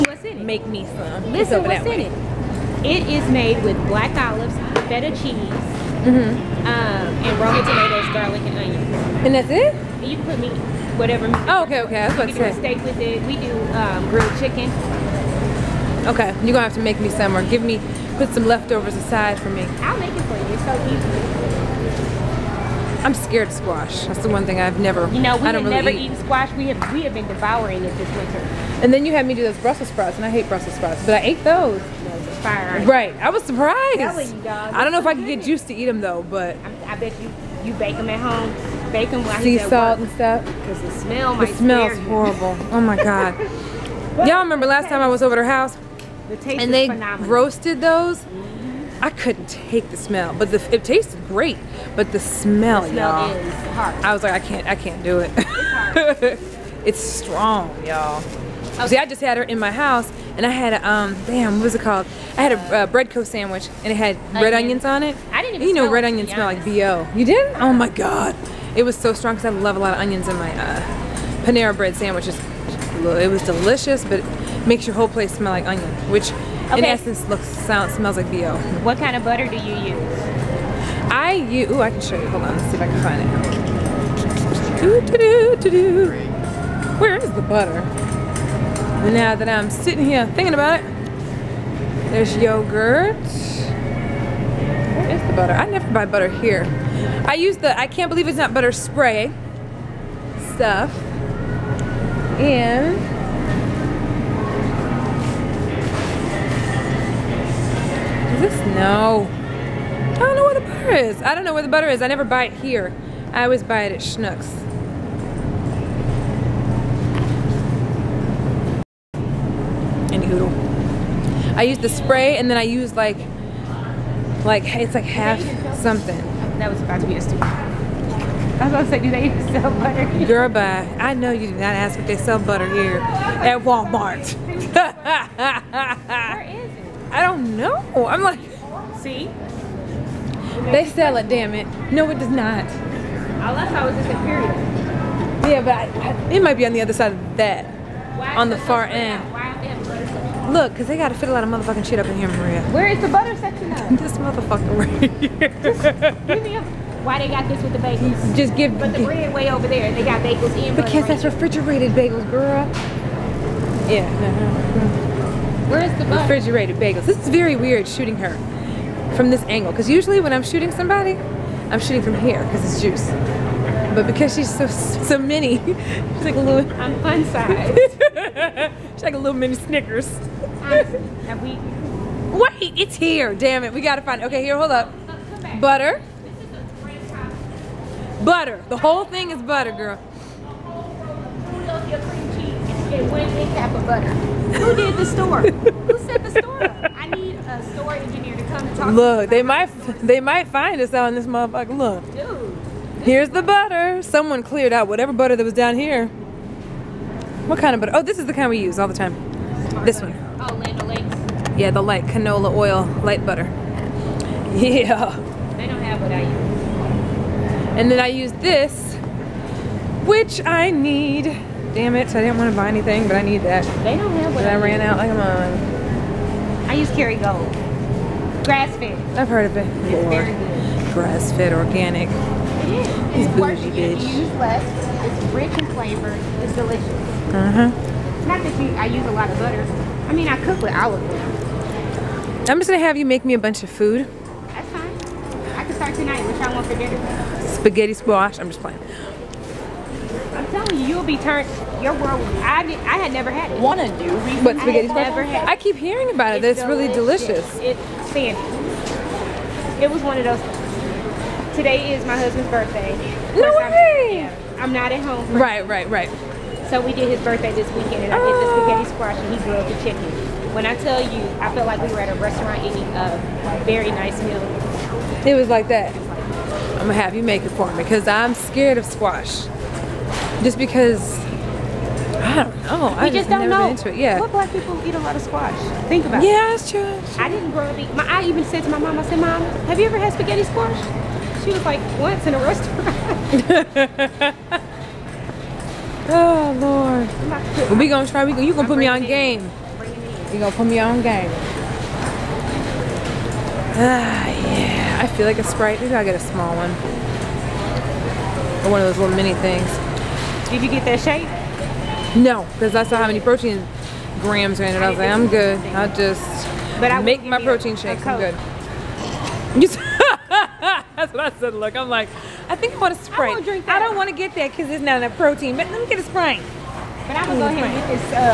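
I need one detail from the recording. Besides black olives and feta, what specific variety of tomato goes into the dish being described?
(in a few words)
Roma.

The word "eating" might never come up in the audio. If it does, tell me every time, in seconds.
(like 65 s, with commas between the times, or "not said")
272 s, 287 s.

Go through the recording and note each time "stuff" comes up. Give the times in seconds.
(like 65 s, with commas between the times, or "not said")
40 s, 100 s.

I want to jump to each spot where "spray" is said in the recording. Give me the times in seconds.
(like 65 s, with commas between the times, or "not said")
98 s, 121 s.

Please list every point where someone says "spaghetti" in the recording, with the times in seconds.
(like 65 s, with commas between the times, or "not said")
247 s, 254 s, 268 s, 290 s.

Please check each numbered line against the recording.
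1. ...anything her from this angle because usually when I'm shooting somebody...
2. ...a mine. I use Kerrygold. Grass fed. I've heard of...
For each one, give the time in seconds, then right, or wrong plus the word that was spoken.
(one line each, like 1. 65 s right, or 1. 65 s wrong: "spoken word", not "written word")
1. 167 s wrong: "shooting", not "anything"
2. 225 s right.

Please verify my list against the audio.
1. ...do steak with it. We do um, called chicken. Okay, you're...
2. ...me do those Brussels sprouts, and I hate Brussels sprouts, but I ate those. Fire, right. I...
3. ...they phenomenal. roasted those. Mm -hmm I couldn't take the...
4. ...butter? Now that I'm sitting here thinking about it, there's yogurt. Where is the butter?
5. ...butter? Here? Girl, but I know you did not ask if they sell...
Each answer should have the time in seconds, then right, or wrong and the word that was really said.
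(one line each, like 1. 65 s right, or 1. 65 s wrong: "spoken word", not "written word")
1. 12 s wrong: "grilled", not "called"
2. 29 s right
3. 46 s right
4. 87 s right
5. 129 s right.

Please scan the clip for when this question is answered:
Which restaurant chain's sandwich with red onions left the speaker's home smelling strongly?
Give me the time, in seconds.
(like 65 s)
62 s.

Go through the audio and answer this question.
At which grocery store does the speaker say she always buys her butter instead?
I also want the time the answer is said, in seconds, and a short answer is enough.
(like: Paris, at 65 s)
Schnucks, at 113 s.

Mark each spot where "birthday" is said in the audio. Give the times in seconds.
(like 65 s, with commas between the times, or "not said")
262 s, 267 s.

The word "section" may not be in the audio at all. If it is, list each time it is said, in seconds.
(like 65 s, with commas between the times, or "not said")
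153 s.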